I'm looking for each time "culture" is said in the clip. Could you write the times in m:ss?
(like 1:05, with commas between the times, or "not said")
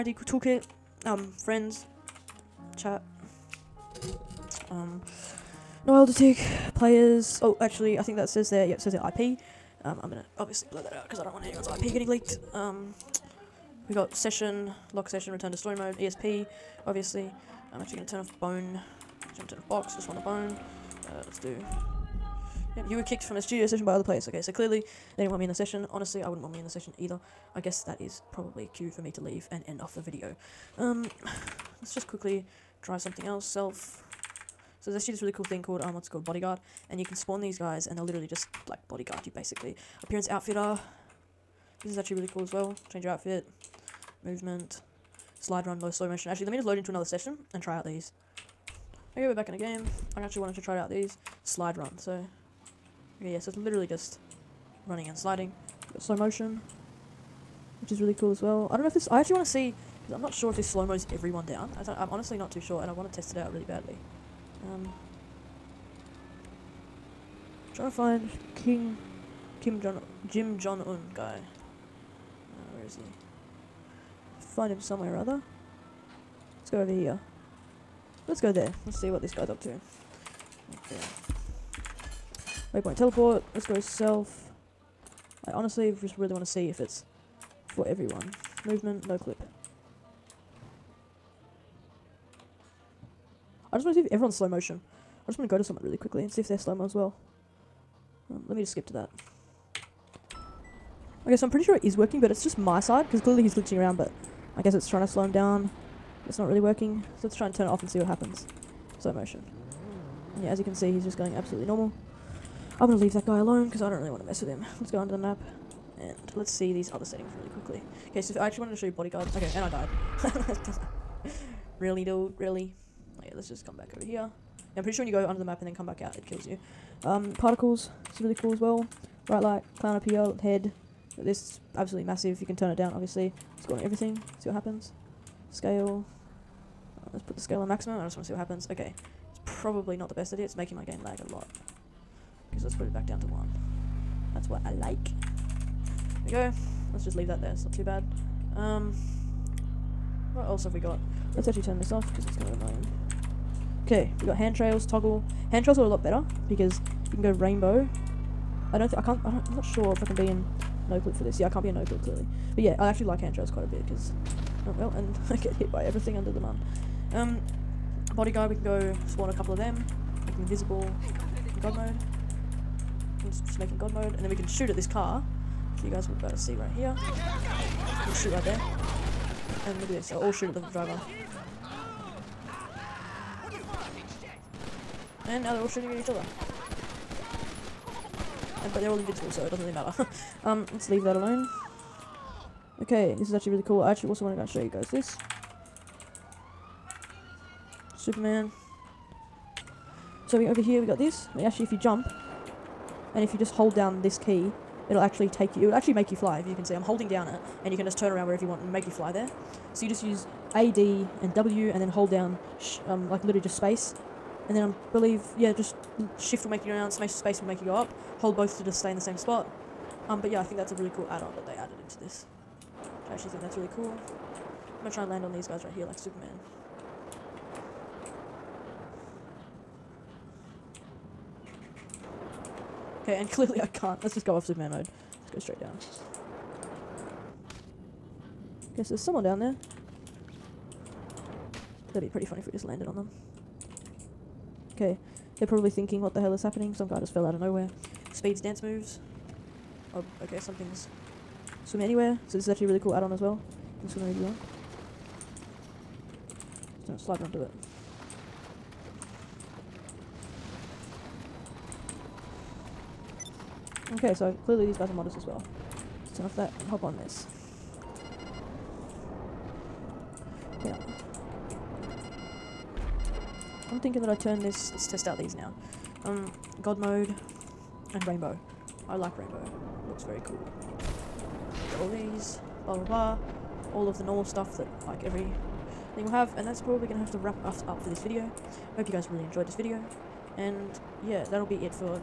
not said.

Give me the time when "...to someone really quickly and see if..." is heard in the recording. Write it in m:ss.
1:35.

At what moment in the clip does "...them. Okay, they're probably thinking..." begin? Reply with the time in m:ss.
4:02.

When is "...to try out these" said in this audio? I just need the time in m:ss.
0:50.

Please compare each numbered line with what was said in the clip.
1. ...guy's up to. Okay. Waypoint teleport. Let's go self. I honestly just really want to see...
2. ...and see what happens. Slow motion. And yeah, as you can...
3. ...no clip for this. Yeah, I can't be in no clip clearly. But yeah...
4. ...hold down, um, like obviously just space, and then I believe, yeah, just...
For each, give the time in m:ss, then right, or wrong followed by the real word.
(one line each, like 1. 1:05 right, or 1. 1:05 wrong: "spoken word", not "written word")
1. 1:19 right
2. 1:47 right
3. 2:40 right
4. 3:31 wrong: "literally", not "obviously".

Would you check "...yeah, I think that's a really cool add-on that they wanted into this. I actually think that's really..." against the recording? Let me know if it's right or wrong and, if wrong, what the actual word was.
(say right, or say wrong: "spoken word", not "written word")
wrong: "added", not "wanted".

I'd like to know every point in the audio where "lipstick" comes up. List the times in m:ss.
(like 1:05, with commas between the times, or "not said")
not said.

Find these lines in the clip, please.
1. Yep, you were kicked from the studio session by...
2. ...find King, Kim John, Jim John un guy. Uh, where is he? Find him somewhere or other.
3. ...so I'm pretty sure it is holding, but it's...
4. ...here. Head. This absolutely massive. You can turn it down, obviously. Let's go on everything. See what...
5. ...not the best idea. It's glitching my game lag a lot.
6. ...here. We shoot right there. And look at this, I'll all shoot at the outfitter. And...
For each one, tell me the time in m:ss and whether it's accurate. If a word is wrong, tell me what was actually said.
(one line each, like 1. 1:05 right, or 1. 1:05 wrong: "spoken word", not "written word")
1. 0:22 right
2. 1:07 right
3. 1:41 wrong: "working", not "holding"
4. 2:10 right
5. 2:19 wrong: "making", not "glitching"
6. 2:56 wrong: "driver", not "outfitter".